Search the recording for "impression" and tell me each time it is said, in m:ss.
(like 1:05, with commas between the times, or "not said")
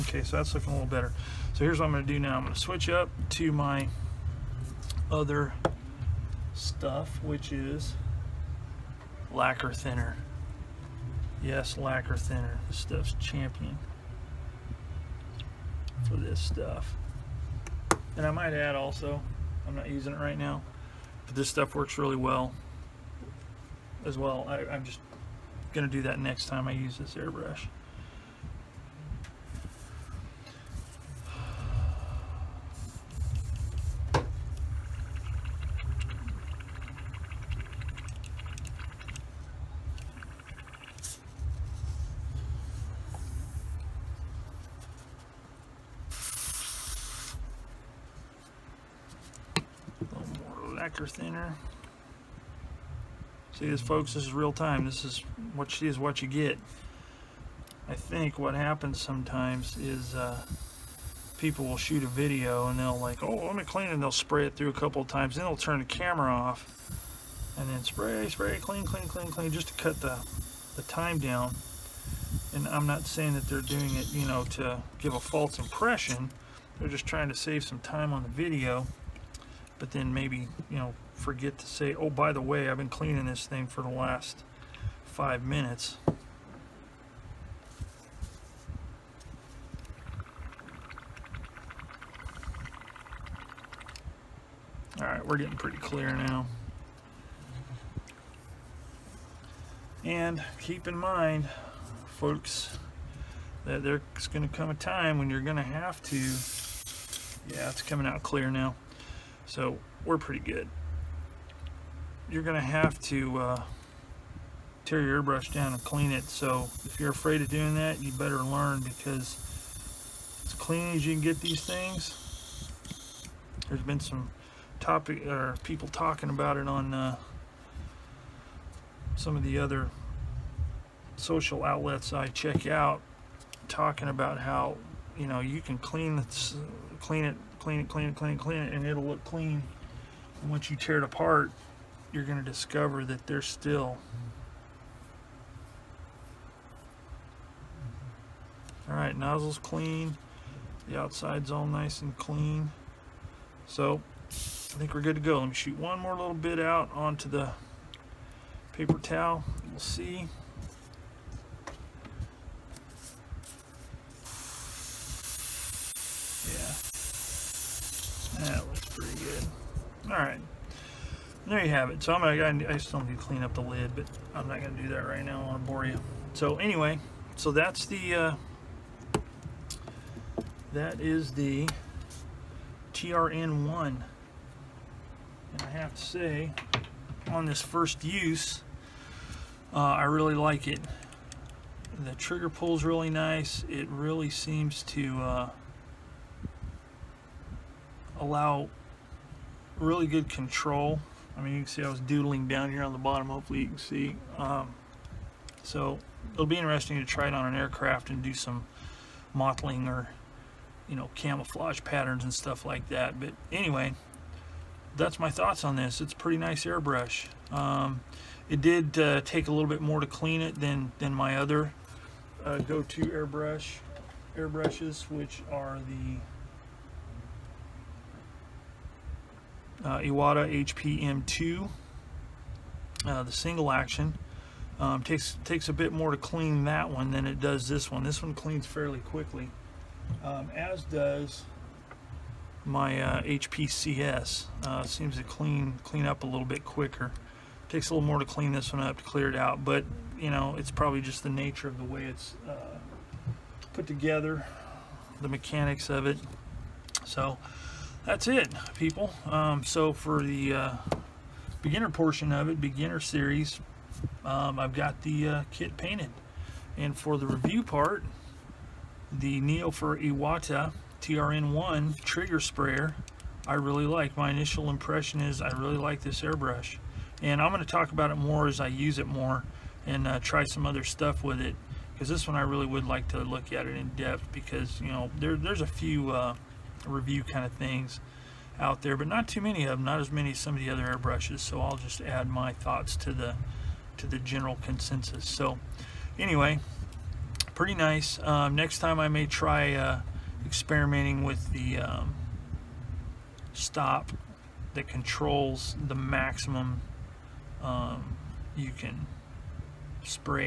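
1:15, 4:34.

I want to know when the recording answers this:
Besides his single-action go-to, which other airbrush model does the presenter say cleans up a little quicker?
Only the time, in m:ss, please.
4:03.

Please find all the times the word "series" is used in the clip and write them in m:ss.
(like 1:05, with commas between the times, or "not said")
4:22.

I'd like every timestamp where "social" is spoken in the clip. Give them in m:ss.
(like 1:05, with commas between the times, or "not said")
2:11.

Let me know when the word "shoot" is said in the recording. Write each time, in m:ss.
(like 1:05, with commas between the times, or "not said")
1:01, 2:35.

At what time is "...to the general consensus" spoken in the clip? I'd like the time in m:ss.
4:53.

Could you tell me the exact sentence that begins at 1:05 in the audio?
Then they'll turn the camera off and then spray, spray, clean, clean, clean, clean, just to cut the, the time down.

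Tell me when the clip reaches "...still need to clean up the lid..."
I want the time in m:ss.
2:52.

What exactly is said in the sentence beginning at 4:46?
Uh, review kind of things out there, but not too many of them, not as many as some of the other airbrushes.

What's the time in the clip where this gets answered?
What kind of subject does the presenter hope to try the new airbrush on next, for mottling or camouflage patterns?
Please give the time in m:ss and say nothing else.
3:27.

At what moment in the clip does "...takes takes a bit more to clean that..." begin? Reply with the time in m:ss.
3:55.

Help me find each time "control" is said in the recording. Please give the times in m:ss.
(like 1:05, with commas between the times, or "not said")
3:20, 5:04.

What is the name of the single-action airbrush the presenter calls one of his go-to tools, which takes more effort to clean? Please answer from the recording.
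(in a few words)
Iwata HPM2.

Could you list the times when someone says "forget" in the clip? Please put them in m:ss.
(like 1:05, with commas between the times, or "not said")
1:21.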